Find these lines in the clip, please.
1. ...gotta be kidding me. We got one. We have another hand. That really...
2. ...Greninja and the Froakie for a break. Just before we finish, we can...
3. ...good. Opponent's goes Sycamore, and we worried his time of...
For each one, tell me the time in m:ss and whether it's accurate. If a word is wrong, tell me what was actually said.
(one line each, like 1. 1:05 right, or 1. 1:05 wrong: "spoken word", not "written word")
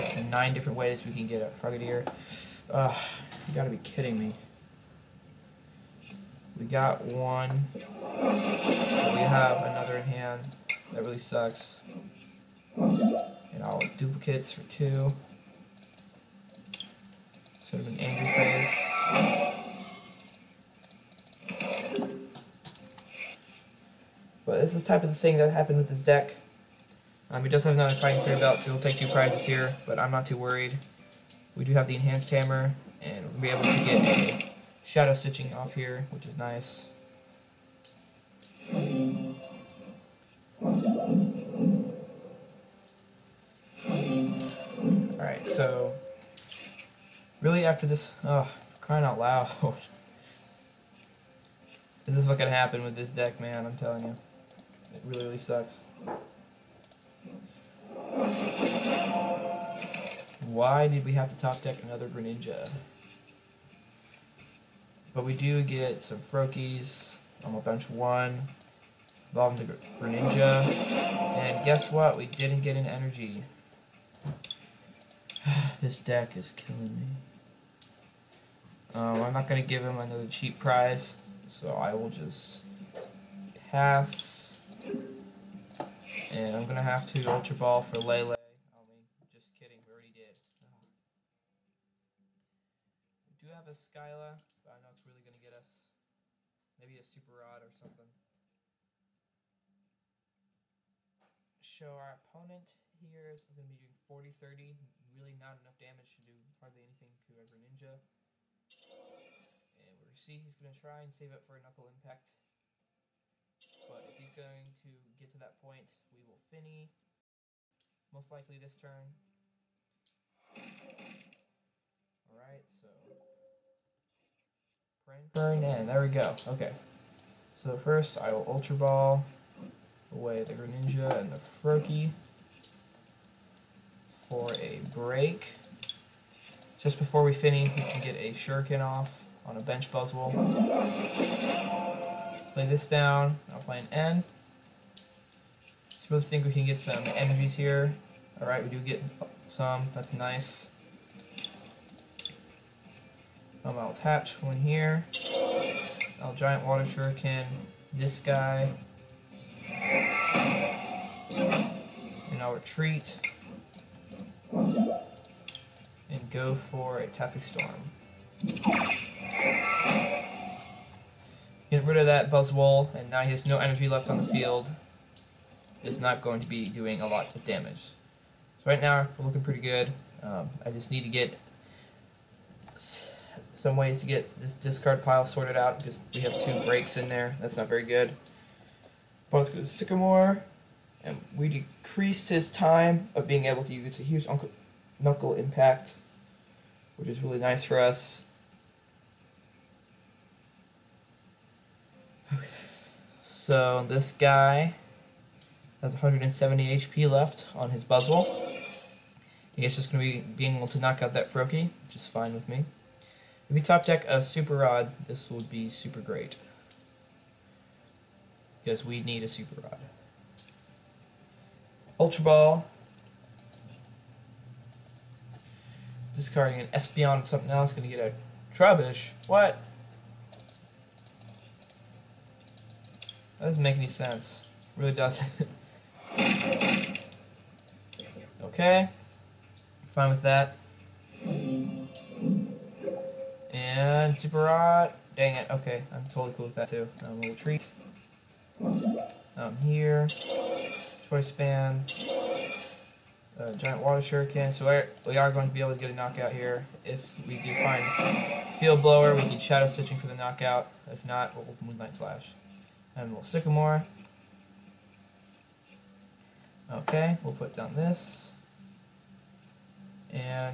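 1. 0:03 right
2. 2:10 right
3. 3:07 wrong: "decreased", not "worried".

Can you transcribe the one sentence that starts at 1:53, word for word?
But if he's going to get to that point, we will Fini, most likely this turn.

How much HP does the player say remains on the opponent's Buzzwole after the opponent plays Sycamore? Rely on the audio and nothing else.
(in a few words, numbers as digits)
170.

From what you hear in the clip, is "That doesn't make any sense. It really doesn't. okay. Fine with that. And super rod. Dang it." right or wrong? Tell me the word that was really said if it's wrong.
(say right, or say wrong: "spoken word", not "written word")
right.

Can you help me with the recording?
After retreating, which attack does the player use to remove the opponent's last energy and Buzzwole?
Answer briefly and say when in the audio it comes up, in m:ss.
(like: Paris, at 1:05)
Tapu Storm, at 2:47.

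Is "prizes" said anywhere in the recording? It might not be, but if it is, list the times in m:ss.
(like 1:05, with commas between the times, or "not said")
0:29, 1:20.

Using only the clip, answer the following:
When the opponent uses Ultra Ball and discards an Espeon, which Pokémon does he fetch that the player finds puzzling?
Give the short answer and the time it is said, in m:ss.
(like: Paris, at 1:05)
Trubbish, at 3:48.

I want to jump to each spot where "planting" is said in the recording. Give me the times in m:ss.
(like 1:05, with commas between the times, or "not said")
not said.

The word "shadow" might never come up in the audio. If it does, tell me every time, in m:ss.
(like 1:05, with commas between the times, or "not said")
0:34, 4:19.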